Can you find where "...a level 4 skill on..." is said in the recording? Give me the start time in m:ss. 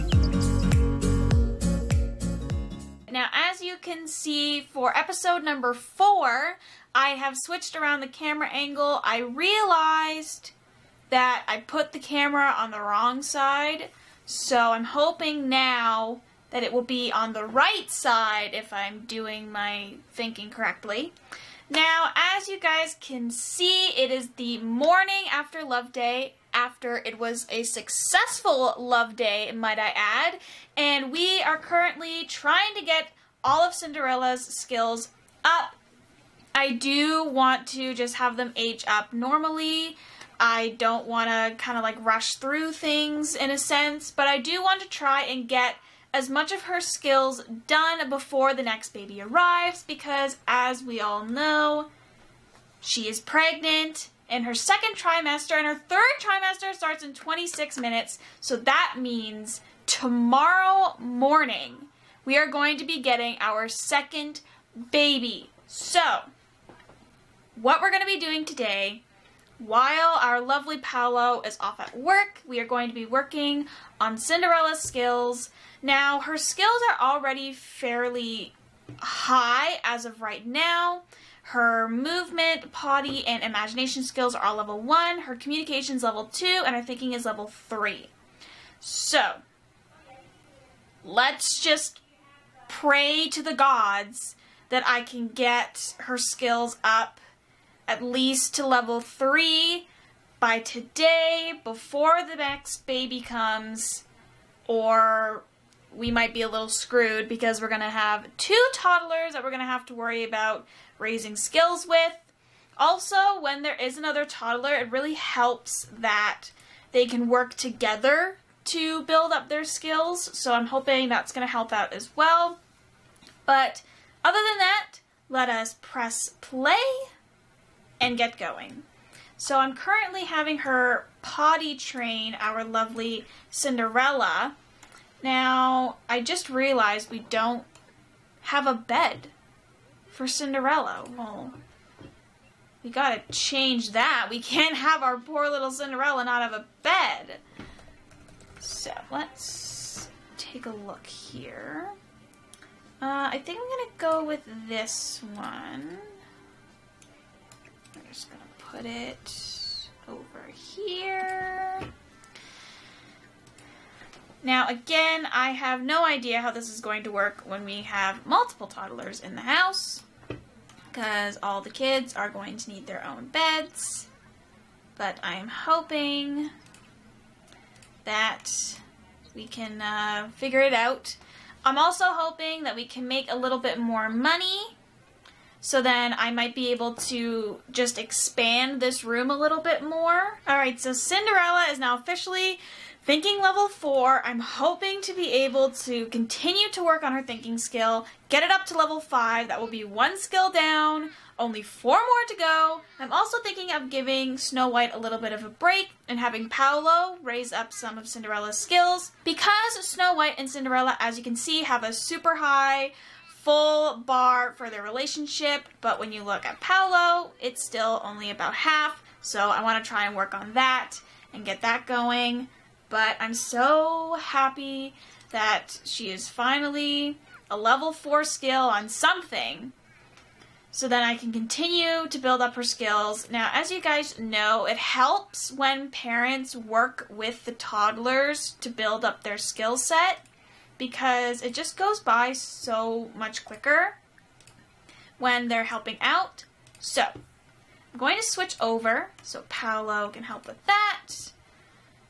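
3:47.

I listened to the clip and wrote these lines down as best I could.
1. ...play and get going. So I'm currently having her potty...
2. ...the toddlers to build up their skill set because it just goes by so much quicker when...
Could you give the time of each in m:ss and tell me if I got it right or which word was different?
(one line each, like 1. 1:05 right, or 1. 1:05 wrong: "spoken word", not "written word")
1. 2:06 right
2. 3:57 right.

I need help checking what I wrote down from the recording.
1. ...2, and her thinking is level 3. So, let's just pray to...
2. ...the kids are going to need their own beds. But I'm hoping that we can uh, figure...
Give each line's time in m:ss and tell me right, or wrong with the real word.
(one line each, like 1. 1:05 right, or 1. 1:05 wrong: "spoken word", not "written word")
1. 1:26 right
2. 2:51 right.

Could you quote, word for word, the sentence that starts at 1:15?
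Now, her skills are already fairly high as of right now.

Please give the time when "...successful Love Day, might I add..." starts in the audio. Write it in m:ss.
0:27.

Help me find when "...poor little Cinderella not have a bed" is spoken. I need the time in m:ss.
2:25.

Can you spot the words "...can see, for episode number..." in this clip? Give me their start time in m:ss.
0:03.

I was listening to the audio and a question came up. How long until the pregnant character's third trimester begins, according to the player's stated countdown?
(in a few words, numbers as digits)
26 minutes.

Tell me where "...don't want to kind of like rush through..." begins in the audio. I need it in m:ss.
0:40.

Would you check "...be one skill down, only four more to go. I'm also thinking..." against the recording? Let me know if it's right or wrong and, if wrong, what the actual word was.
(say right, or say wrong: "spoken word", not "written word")
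right.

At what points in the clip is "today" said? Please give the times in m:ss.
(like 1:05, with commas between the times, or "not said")
1:08, 1:40.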